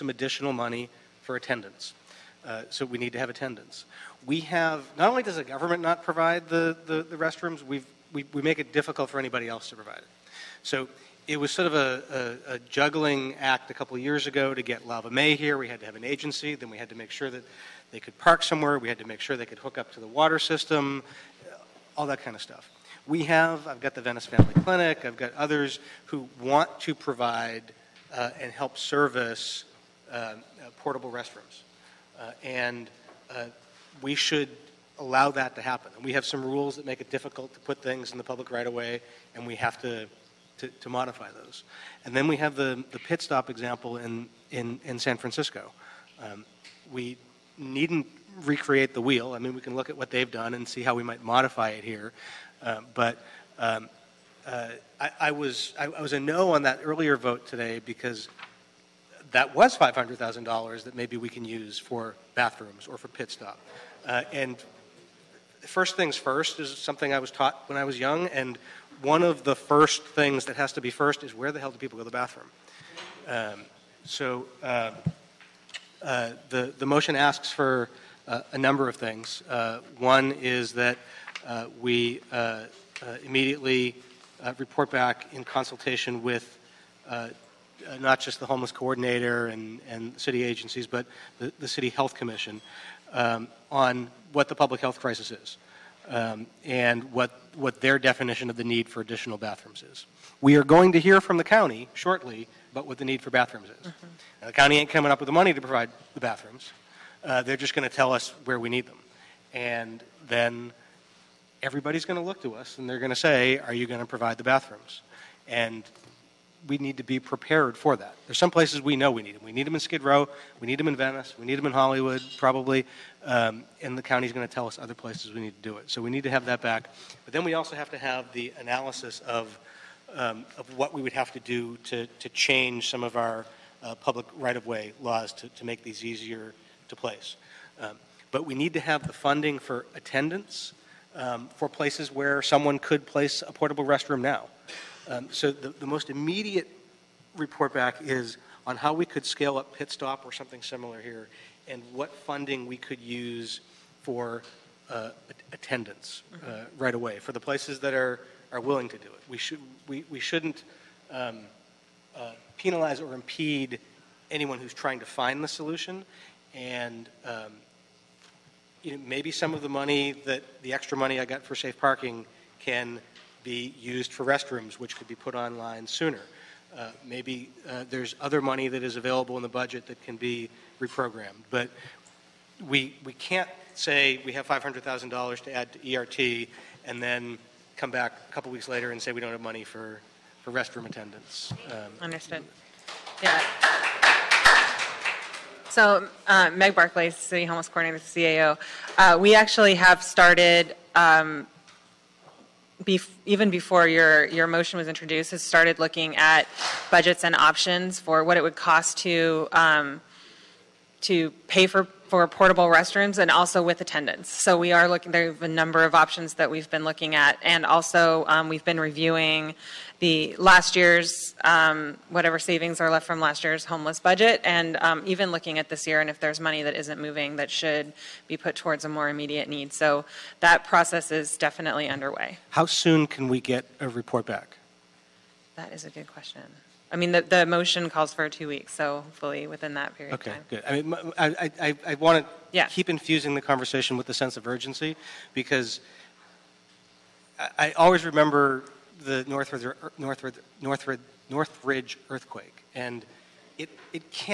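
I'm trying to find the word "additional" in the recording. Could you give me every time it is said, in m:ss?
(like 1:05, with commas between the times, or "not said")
0:00, 1:39.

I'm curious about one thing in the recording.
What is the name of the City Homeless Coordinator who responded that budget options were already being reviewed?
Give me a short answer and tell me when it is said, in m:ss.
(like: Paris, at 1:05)
Meg Barclay, at 3:16.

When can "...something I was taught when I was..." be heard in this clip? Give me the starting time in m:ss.
1:06.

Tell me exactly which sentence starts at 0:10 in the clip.
So it was sort of a, a, a, juggling act a couple of years ago to get Lava Mae here.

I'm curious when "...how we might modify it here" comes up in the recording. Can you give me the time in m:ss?
0:50.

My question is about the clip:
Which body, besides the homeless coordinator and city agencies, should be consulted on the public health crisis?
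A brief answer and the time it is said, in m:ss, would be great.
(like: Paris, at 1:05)
City Health Commission, at 1:31.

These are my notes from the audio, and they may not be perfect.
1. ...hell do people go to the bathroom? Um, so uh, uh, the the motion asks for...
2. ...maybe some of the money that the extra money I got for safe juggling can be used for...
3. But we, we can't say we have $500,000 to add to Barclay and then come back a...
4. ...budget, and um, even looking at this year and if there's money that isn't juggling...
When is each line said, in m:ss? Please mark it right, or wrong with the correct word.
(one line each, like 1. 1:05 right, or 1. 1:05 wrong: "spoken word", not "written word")
1. 1:11 right
2. 2:49 wrong: "parking", not "juggling"
3. 3:01 wrong: "ERT", not "Barclay"
4. 3:44 wrong: "moving", not "juggling".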